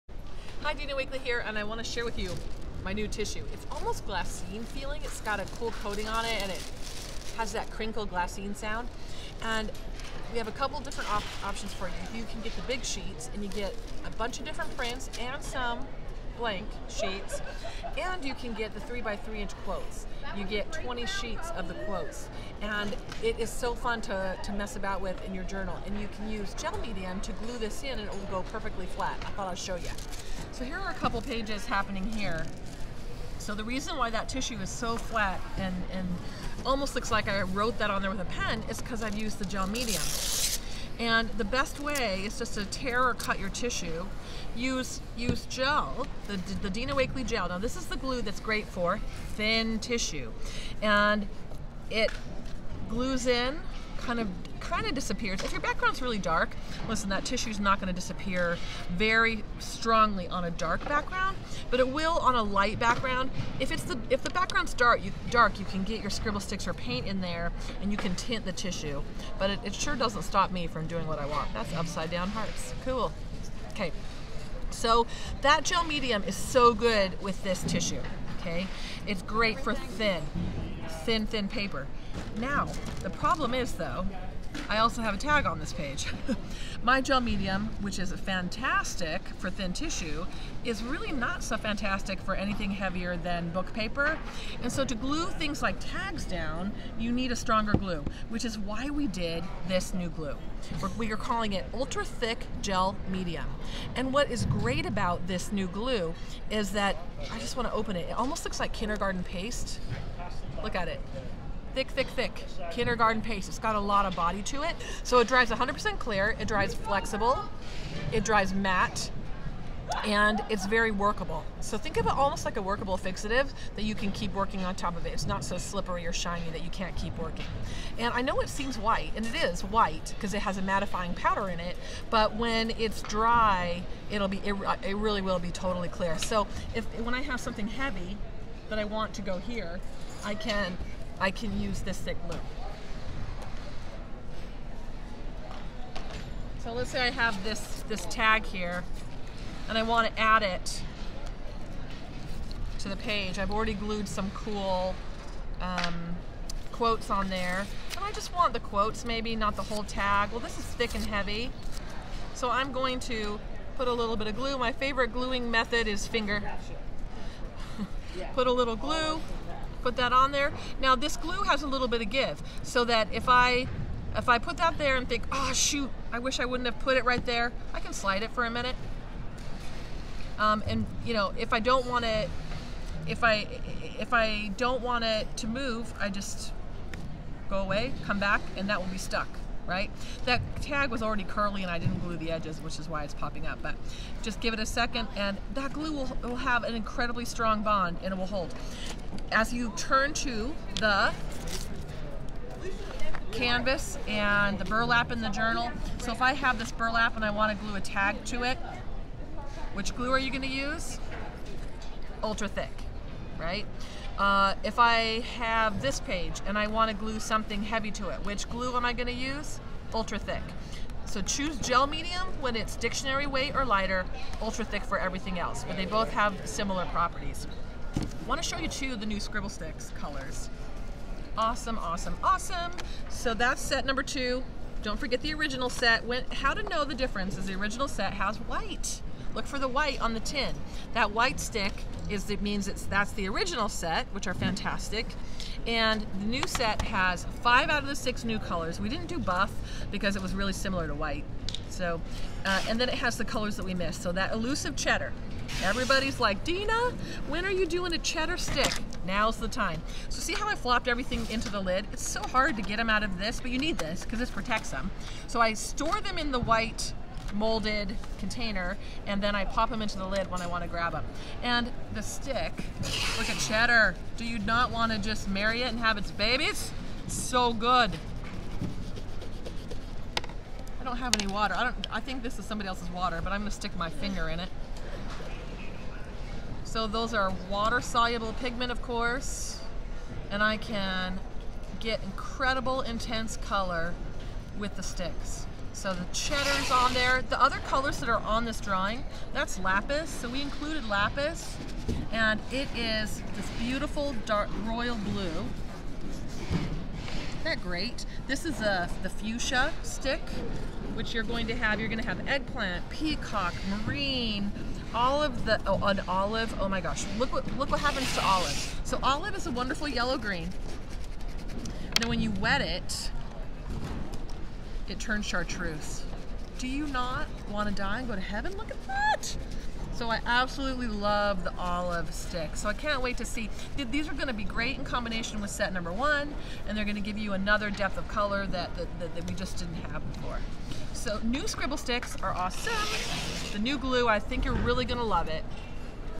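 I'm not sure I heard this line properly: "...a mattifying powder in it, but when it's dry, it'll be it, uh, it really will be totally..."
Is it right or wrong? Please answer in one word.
right.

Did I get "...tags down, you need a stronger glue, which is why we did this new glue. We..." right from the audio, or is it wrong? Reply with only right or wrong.
right.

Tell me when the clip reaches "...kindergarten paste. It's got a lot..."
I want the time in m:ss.
1:52.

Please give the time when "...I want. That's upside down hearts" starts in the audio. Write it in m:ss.
1:11.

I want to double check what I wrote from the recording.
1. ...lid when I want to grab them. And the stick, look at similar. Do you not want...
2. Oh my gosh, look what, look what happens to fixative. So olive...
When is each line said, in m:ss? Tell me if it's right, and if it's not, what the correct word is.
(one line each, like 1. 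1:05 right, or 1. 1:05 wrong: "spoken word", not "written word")
1. 4:30 wrong: "cheddar", not "similar"
2. 5:16 wrong: "olive", not "fixative".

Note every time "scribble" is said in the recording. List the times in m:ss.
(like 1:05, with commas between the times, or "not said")
1:06, 3:49, 5:41.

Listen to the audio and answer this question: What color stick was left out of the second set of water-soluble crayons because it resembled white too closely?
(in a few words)
buff.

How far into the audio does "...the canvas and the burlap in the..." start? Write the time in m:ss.
3:20.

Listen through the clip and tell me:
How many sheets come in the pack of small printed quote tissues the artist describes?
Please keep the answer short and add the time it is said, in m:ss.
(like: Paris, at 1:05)
20, at 0:20.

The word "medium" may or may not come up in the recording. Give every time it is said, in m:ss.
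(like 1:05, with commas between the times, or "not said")
0:26, 0:39, 1:15, 1:27, 1:43, 3:41.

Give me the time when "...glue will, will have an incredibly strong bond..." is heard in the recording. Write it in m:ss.
3:15.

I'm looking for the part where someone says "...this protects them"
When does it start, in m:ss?
4:24.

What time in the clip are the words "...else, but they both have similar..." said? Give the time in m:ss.
3:45.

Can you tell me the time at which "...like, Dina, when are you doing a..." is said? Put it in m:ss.
4:16.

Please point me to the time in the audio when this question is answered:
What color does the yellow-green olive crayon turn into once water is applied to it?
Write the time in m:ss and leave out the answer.
5:25.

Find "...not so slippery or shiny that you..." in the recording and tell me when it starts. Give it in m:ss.
2:05.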